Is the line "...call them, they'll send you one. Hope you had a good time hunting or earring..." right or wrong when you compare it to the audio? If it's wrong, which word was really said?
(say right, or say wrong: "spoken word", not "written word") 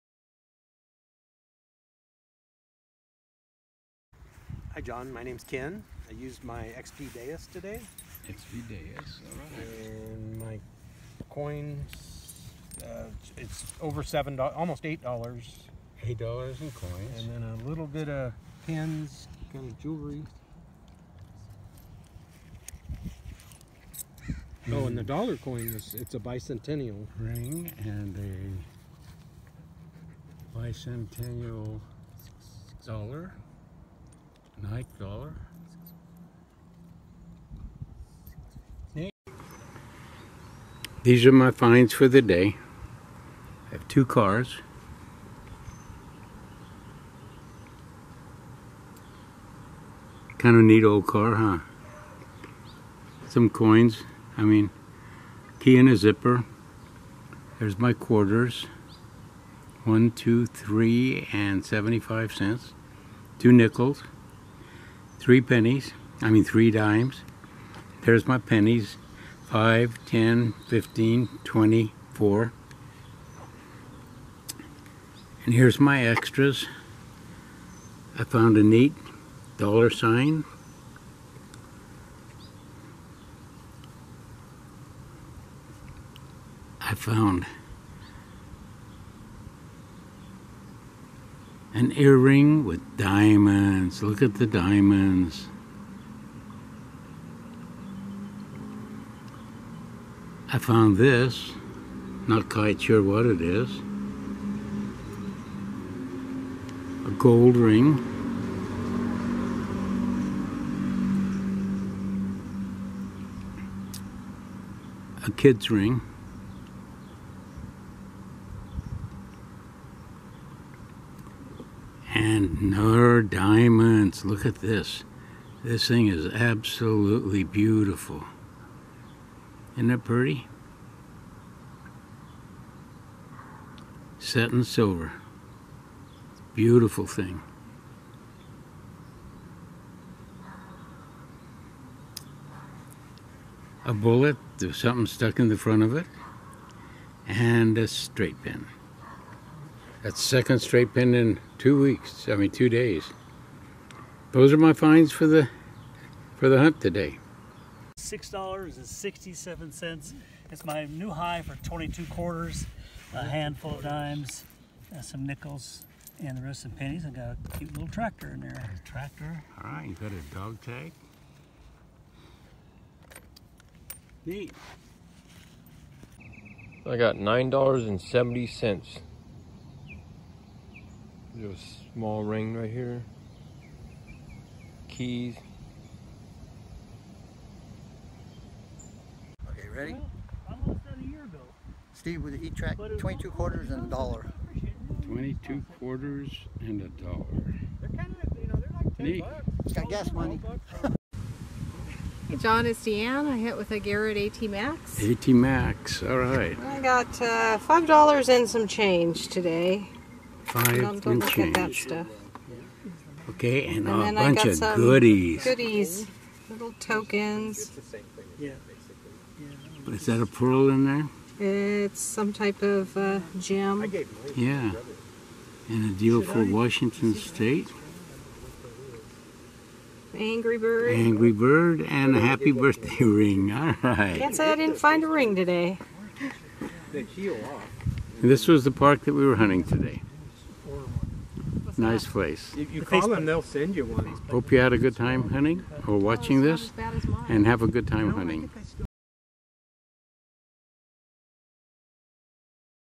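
wrong: "watching", not "earring".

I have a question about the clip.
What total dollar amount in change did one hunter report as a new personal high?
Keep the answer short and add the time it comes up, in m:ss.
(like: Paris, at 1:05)
$6.67, at 2:37.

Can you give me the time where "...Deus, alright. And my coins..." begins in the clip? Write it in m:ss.
0:08.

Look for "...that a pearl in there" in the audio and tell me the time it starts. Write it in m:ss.
3:40.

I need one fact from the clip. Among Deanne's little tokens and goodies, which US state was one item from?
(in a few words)
Washington.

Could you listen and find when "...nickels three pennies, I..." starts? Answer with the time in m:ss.
1:03.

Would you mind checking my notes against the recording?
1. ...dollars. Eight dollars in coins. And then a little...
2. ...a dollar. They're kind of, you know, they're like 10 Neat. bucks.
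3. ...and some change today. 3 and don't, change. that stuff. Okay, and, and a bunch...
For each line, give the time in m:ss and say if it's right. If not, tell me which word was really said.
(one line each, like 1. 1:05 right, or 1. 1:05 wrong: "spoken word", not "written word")
1. 0:15 right
2. 3:16 right
3. 3:28 wrong: "5", not "3".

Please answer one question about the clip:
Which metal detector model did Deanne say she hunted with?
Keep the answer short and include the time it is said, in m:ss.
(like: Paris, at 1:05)
Garrett AT Max, at 3:23.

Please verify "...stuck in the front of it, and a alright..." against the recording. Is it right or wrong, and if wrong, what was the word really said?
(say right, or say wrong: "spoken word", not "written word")
wrong: "straight", not "alright".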